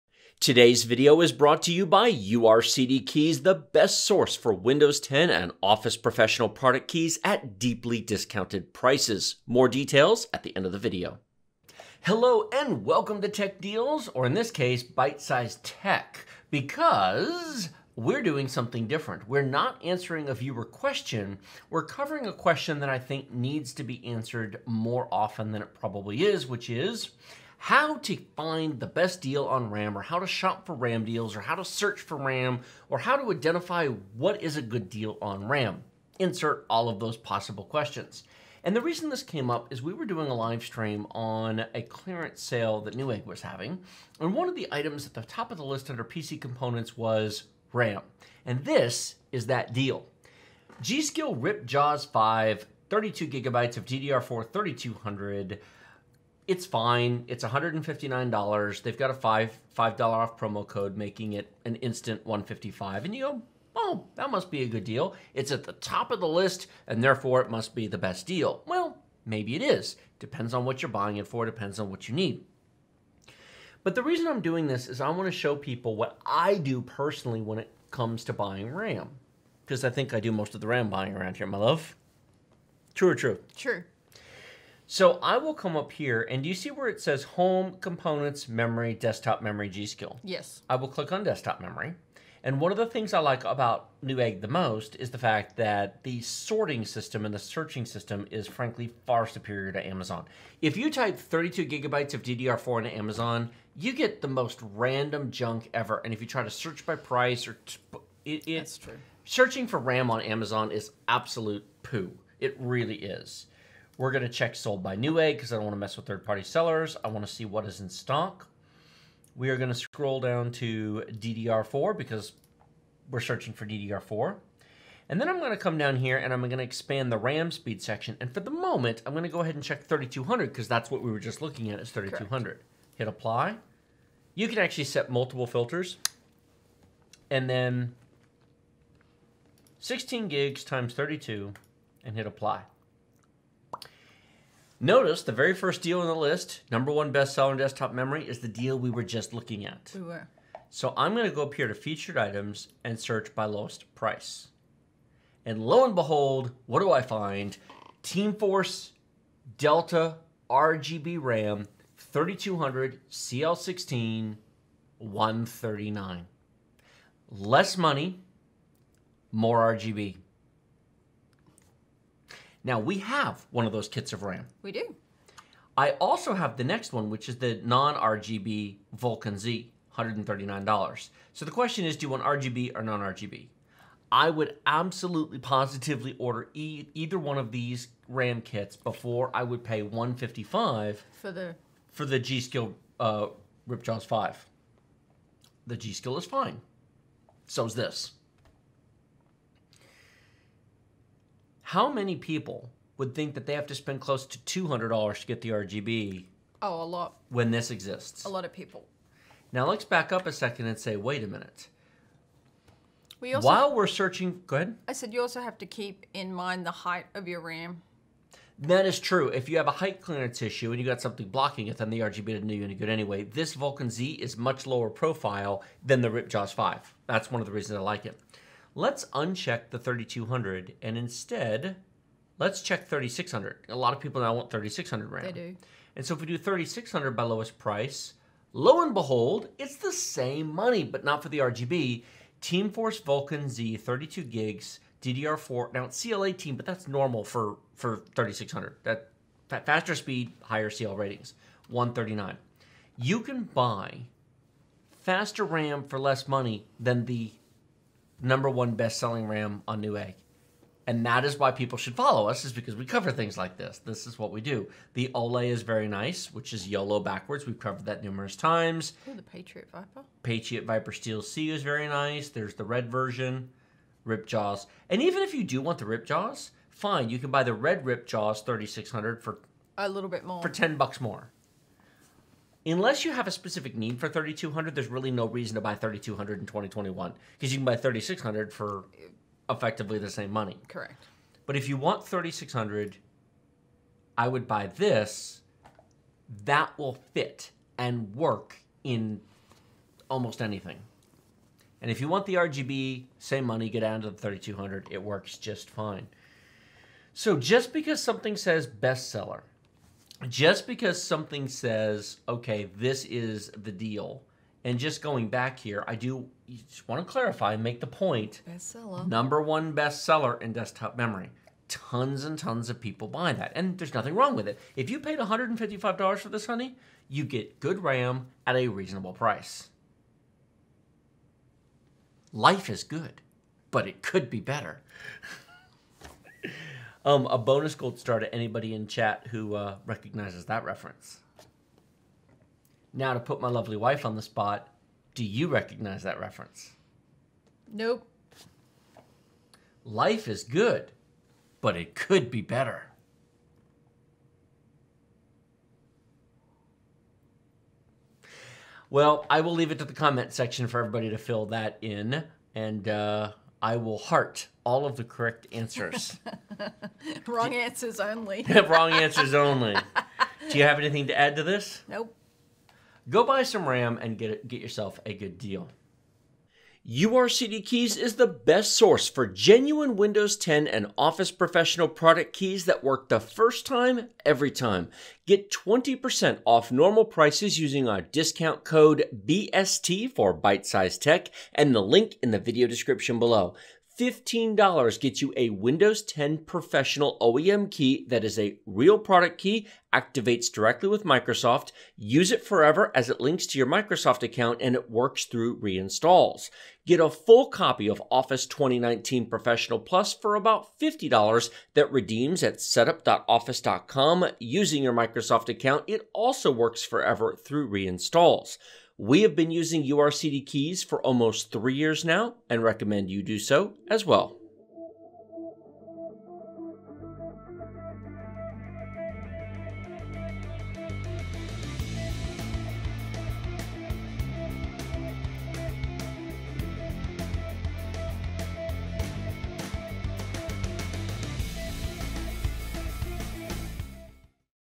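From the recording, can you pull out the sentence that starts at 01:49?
Searching for RAM on Amazon is absolute poo.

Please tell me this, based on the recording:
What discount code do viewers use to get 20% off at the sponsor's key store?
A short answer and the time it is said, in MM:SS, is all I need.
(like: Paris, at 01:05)
BST, at 06:29.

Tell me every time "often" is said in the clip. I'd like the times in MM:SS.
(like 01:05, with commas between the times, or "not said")
00:25.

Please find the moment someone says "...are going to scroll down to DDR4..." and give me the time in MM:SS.
01:59.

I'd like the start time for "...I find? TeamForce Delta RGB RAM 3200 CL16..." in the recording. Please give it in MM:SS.
02:36.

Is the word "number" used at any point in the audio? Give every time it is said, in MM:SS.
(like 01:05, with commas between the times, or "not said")
02:26, 04:18, 05:19.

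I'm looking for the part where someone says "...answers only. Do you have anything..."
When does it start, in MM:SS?
06:08.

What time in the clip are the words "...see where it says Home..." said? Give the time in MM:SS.
01:26.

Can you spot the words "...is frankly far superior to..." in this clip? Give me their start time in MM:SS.
01:38.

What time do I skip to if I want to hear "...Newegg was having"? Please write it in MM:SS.
00:42.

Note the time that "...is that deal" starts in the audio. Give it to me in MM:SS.
00:49.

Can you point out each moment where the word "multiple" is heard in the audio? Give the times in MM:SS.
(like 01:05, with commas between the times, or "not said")
02:15.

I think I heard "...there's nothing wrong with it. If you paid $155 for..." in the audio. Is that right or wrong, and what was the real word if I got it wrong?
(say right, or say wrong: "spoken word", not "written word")
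right.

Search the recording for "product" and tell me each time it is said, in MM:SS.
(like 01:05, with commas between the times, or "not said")
00:06, 06:21, 06:38.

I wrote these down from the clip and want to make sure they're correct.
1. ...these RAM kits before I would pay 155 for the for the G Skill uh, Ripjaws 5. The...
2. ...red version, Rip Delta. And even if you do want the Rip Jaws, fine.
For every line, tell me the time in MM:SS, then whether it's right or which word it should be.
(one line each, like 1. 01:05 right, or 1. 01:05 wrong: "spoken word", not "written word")
1. 03:07 right
2. 04:32 wrong: "Jaws", not "Delta".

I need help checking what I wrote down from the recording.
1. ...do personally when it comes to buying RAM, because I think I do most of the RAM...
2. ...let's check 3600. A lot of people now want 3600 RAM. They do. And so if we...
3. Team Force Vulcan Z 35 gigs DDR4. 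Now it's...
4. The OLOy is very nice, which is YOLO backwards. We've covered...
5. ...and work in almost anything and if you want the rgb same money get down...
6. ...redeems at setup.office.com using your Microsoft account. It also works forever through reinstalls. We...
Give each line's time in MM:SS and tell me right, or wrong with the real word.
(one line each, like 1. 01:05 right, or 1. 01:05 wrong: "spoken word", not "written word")
1. 01:16 right
2. 03:52 right
3. 04:02 wrong: "32", not "35"
4. 04:24 right
5. 04:57 right
6. 06:51 right.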